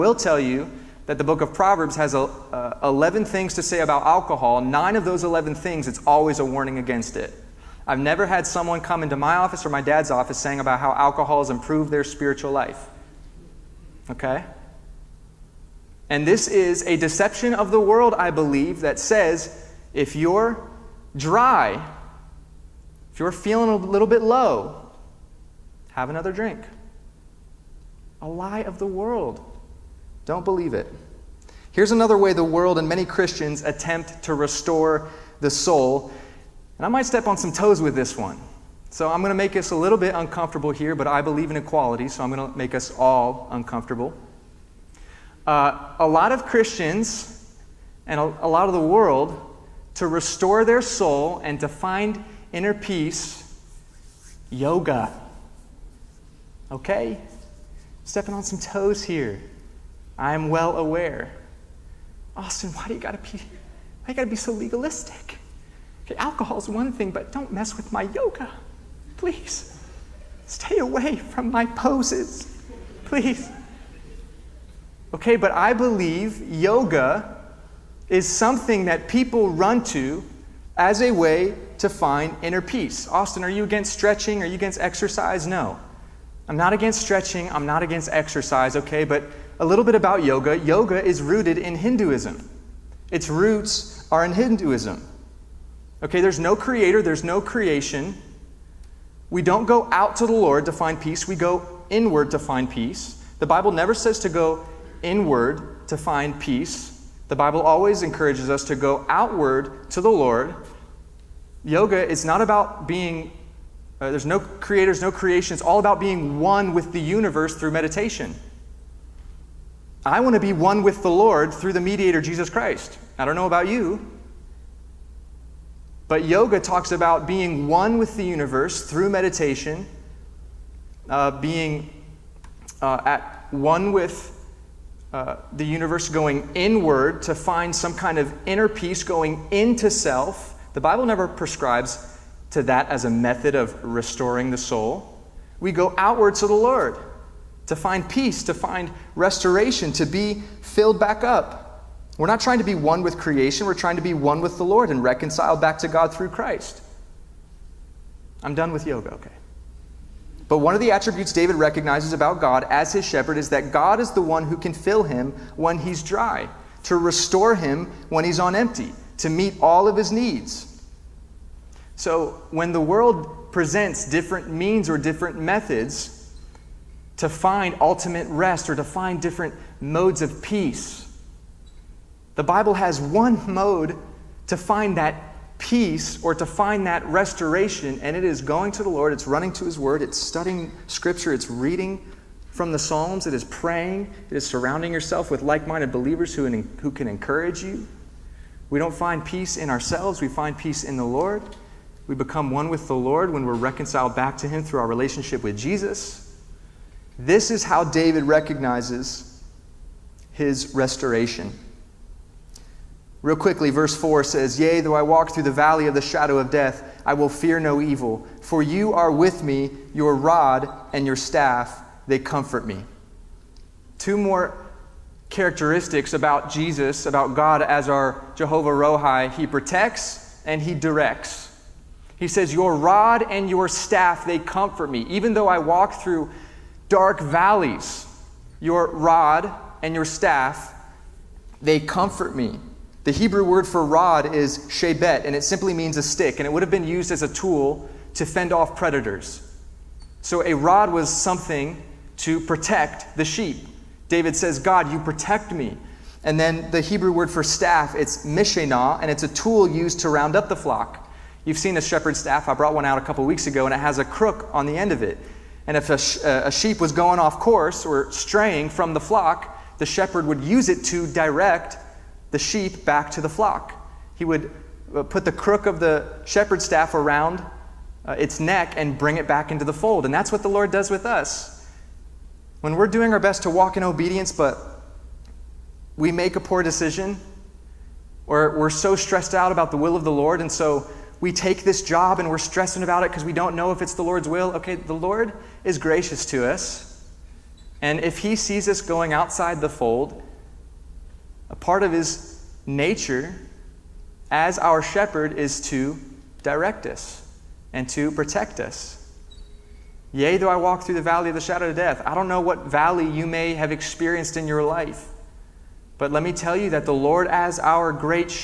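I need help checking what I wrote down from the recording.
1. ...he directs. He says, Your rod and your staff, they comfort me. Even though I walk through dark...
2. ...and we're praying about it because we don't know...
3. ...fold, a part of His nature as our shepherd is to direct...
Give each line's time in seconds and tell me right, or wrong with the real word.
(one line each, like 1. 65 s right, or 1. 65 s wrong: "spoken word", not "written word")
1. 230 s right
2. 292 s wrong: "stressing", not "praying"
3. 299 s right.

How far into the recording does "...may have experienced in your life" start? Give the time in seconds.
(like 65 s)
313 s.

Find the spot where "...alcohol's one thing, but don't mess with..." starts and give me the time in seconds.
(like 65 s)
66 s.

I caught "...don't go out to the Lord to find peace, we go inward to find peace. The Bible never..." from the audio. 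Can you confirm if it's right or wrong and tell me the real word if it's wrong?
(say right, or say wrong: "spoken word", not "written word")
right.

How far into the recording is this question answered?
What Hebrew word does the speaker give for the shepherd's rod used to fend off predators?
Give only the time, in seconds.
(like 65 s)
244 s.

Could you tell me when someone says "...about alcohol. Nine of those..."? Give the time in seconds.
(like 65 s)
3 s.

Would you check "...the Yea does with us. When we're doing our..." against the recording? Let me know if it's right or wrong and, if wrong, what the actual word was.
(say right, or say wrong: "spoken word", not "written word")
wrong: "Lord", not "Yea".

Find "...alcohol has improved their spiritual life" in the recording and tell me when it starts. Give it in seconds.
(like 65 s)
10 s.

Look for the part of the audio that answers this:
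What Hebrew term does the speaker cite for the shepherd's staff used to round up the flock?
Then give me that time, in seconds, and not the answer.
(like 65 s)
258 s.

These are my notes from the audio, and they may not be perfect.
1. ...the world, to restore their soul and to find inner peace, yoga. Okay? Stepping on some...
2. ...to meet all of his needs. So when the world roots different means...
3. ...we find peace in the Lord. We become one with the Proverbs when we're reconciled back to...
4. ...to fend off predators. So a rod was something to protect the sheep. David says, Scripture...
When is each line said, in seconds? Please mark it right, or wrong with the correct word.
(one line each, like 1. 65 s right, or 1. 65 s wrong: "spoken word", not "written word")
1. 48 s right
2. 169 s wrong: "presents", not "roots"
3. 200 s wrong: "Lord", not "Proverbs"
4. 248 s wrong: "God", not "Scripture".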